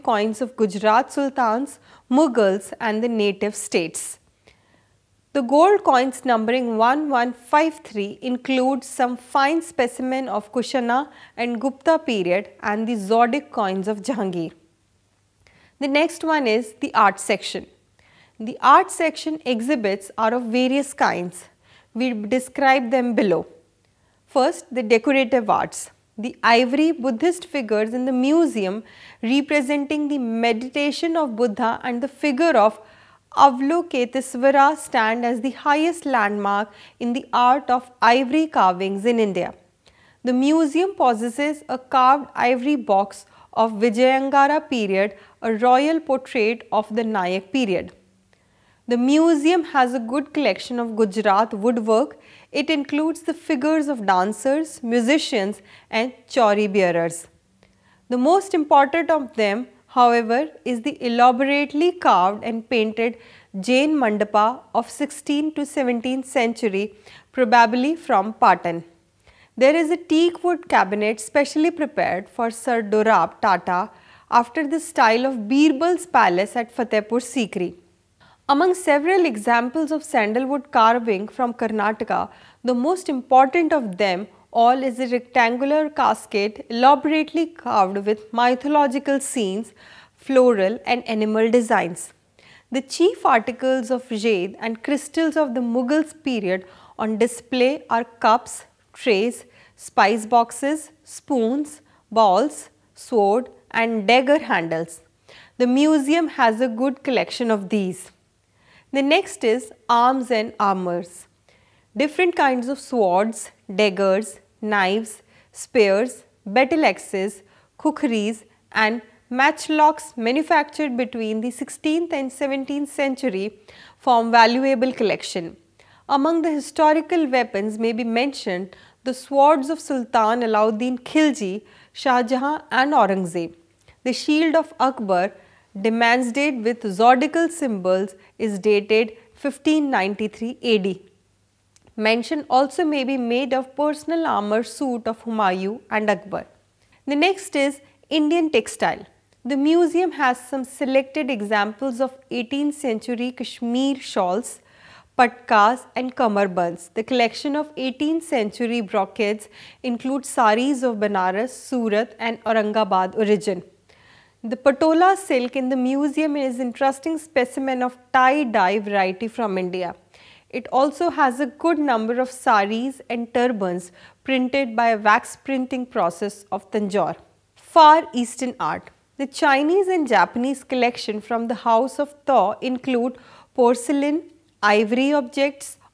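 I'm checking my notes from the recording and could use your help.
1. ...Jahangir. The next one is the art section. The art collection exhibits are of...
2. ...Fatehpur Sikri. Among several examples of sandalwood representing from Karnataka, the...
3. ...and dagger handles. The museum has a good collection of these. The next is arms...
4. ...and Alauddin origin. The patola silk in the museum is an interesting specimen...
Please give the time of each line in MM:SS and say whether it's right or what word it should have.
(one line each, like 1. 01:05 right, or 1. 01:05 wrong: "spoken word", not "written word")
1. 00:14 wrong: "section", not "collection"
2. 01:16 wrong: "carving", not "representing"
3. 01:43 right
4. 02:42 wrong: "Aurangabad", not "Alauddin".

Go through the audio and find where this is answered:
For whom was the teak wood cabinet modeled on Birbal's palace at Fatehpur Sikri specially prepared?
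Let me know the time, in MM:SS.
01:12.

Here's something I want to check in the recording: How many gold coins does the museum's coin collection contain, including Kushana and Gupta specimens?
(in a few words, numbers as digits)
1153.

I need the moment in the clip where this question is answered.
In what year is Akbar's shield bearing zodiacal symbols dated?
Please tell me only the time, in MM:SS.
02:19.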